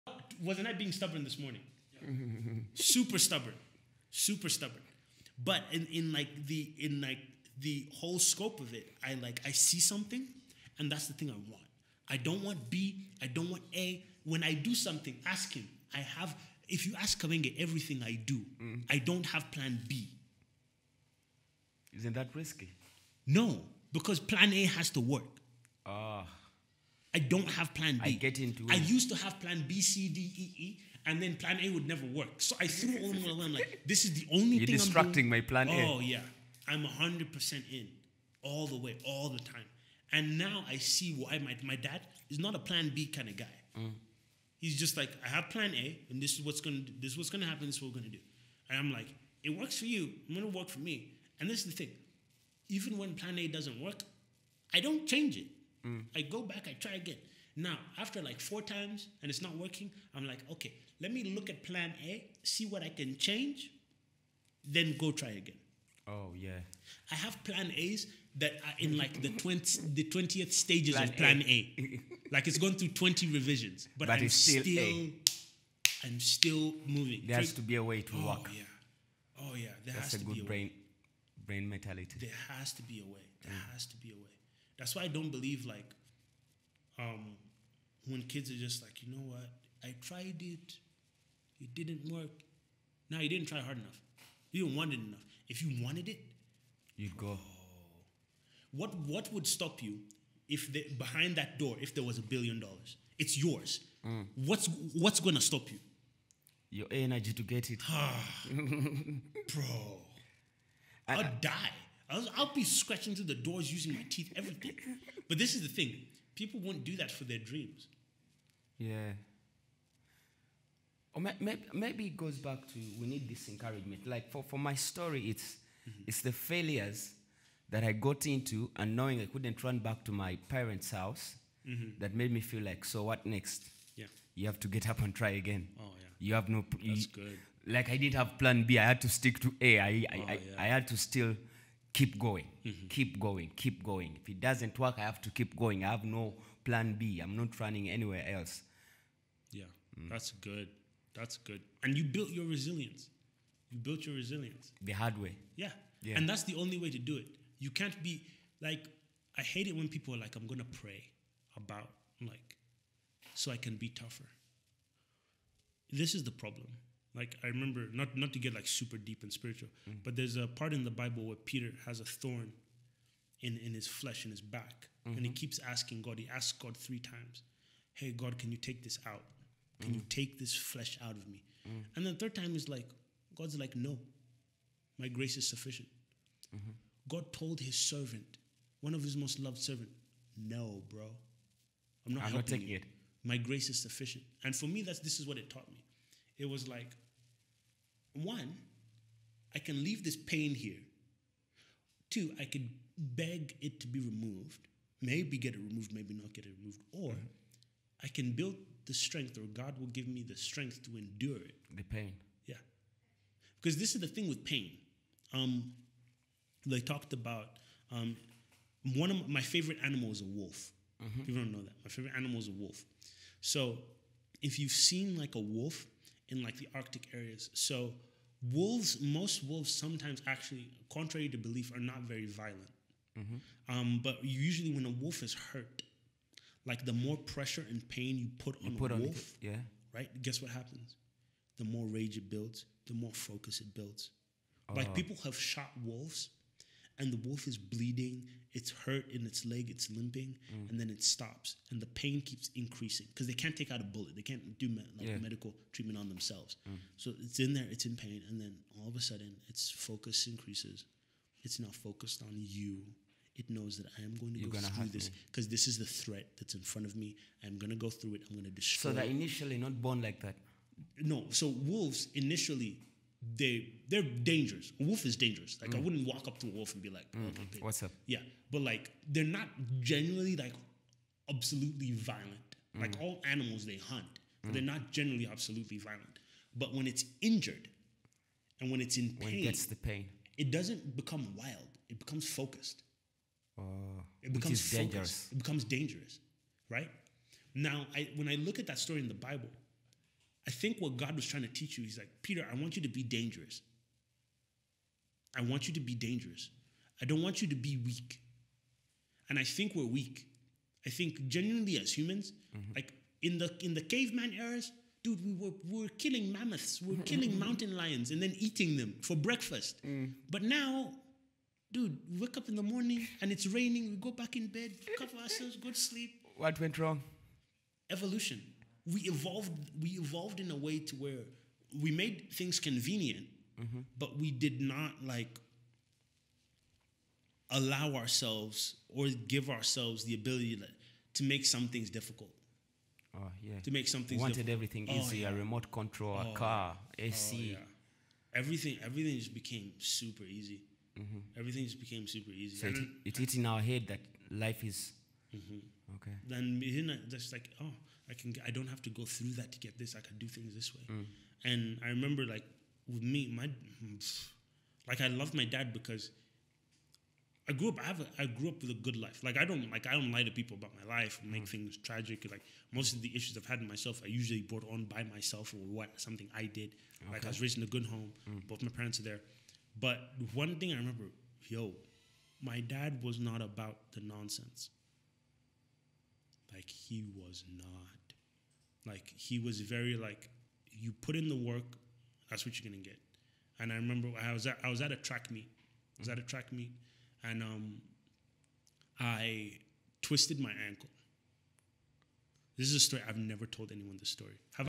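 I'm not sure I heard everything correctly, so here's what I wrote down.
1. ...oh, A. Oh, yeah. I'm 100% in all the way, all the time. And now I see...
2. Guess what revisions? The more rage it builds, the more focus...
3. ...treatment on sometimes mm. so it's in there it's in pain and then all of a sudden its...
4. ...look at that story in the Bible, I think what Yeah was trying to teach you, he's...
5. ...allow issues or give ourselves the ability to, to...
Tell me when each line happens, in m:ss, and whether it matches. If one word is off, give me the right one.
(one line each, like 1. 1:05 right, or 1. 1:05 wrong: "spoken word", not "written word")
1. 0:35 right
2. 4:00 wrong: "happens", not "revisions"
3. 4:15 wrong: "themselves", not "sometimes"
4. 4:58 wrong: "God", not "Yeah"
5. 5:37 wrong: "ourselves", not "issues".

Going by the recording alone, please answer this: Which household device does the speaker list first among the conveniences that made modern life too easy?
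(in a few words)
remote control.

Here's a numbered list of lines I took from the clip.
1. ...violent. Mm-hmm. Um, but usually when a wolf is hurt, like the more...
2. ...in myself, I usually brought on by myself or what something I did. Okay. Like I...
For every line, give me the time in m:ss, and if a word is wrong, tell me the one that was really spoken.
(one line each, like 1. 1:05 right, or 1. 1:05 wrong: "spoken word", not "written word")
1. 3:52 right
2. 6:13 right.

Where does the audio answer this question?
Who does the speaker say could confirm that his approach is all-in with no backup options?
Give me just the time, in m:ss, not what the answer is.
0:17.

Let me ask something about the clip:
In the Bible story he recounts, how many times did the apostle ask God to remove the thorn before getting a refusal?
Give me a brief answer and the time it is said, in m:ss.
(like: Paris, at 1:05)
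3, at 2:56.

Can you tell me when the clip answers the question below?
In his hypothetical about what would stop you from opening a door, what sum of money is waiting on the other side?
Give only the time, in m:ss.
1:42.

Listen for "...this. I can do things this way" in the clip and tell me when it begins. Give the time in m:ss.
5:59.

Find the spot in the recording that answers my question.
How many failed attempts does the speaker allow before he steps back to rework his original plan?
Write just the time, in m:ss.
0:58.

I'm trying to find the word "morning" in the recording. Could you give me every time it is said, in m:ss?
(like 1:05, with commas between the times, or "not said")
0:01, 5:22.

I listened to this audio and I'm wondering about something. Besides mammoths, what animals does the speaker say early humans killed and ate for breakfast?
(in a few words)
mountain lions.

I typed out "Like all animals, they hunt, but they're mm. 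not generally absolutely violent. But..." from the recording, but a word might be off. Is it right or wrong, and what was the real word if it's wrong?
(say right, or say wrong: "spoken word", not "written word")
right.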